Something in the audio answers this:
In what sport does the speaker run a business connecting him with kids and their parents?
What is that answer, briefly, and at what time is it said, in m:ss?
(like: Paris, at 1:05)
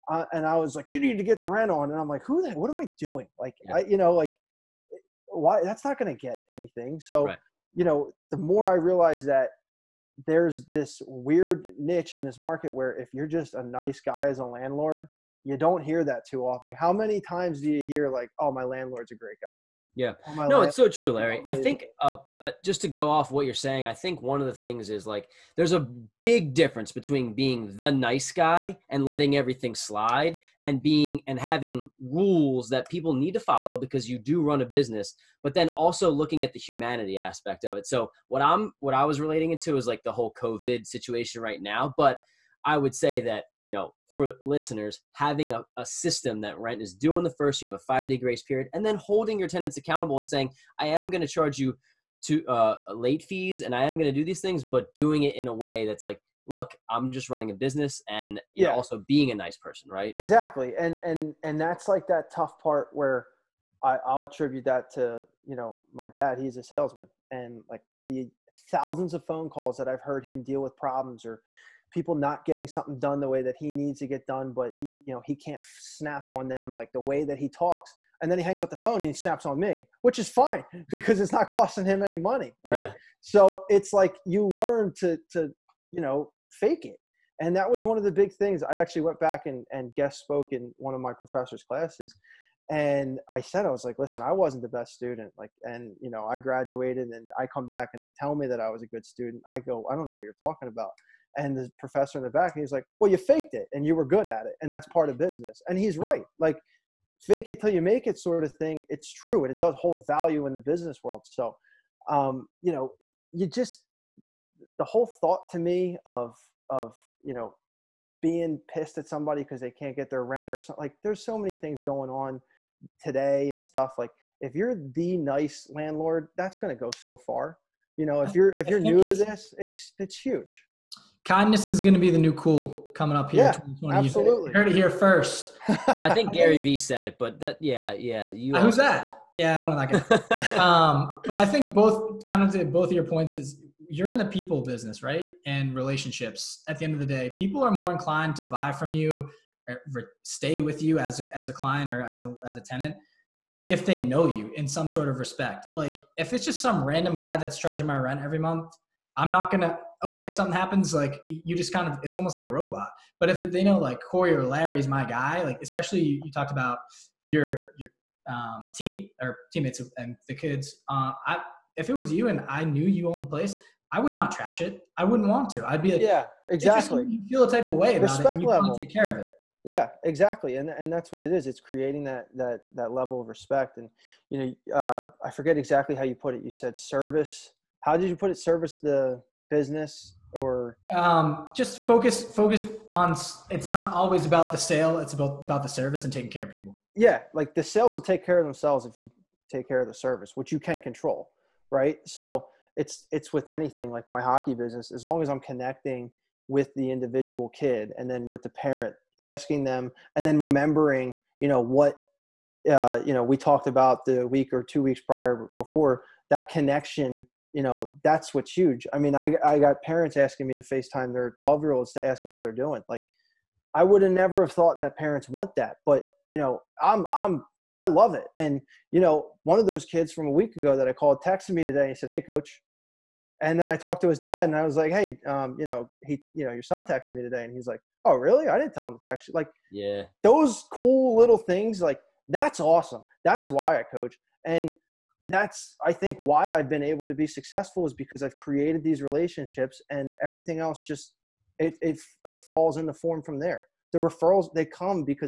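Hockey, at 3:24.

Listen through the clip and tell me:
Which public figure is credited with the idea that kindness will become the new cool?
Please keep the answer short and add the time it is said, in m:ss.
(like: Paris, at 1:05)
Gary Vee, at 2:16.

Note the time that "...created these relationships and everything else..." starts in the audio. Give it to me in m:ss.
4:08.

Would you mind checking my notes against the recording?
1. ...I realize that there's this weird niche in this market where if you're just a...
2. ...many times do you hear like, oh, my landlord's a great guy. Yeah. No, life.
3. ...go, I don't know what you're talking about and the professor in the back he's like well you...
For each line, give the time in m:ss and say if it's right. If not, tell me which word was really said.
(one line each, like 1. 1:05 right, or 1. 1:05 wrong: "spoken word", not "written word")
1. 0:08 right
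2. 0:16 right
3. 1:39 right.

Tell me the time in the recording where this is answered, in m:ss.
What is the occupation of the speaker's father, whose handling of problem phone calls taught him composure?
1:06.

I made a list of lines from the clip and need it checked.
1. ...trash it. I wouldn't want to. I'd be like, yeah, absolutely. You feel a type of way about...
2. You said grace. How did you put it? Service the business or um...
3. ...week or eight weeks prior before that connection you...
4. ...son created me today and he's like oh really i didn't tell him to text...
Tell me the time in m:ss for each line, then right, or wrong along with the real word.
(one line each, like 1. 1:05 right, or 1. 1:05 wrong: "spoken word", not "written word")
1. 2:54 wrong: "exactly", not "absolutely"
2. 3:06 wrong: "service", not "grace"
3. 3:34 wrong: "two", not "eight"
4. 3:56 wrong: "texted", not "created".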